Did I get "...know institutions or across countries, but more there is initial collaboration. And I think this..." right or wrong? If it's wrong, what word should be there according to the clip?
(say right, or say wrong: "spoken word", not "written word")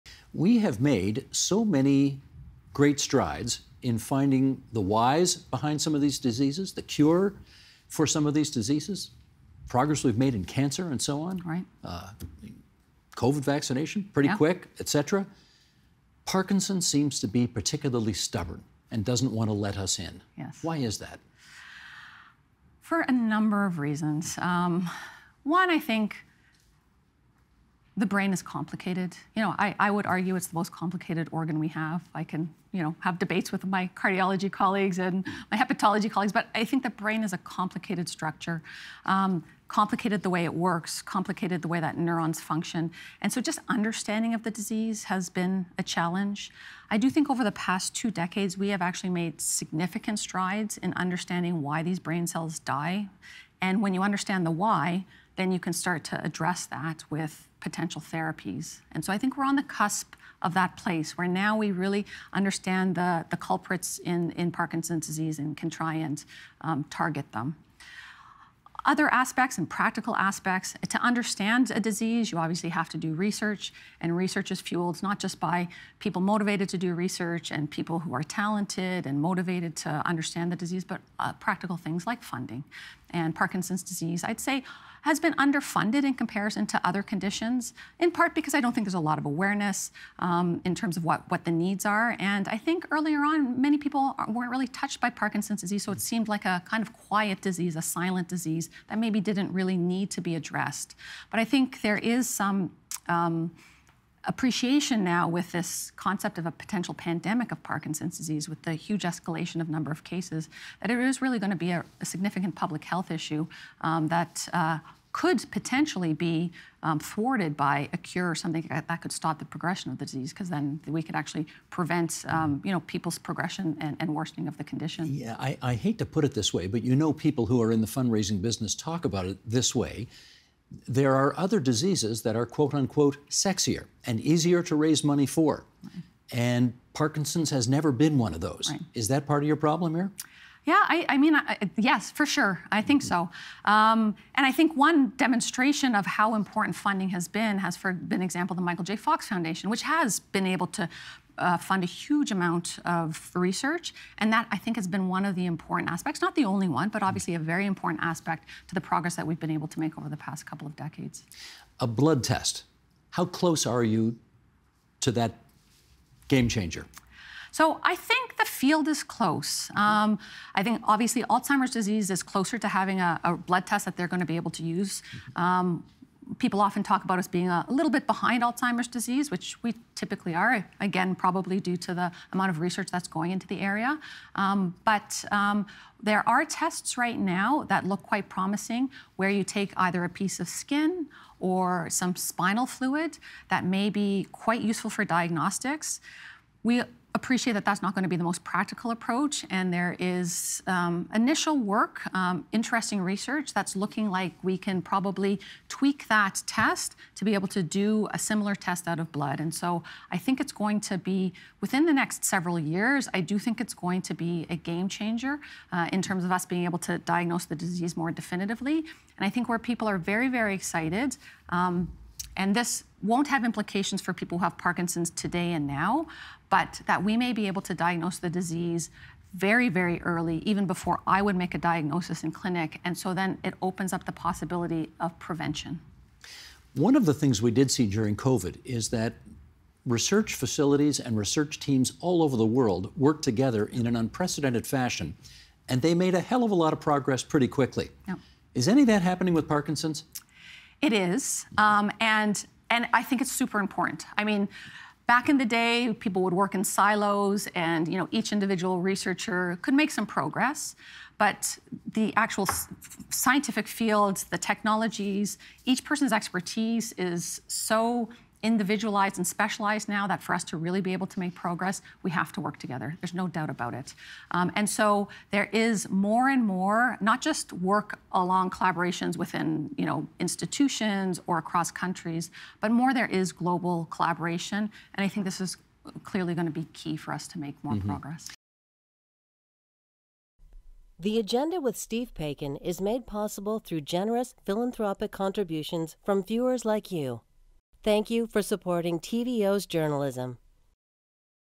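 wrong: "global", not "initial".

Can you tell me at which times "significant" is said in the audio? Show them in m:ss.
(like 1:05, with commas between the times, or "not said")
0:49, 1:52.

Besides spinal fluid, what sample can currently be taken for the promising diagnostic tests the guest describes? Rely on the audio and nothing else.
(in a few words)
a piece of skin.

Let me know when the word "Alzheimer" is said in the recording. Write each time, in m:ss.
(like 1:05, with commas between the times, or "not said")
2:51, 2:58.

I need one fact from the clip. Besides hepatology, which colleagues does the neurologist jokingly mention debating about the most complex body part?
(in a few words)
cardiology colleagues.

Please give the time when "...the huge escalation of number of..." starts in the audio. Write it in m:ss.
1:48.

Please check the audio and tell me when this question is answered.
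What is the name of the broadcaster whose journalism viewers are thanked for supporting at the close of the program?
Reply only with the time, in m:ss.
4:58.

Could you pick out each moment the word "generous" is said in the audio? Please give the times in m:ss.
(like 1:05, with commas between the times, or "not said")
4:53.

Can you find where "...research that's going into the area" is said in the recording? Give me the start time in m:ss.
3:02.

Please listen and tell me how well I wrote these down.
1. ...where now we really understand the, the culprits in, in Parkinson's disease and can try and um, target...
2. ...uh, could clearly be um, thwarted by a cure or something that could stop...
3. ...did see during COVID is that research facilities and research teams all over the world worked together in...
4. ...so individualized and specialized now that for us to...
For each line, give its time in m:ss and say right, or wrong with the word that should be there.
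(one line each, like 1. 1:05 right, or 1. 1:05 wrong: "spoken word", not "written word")
1. 1:01 right
2. 1:54 wrong: "potentially", not "clearly"
3. 3:57 right
4. 4:27 right.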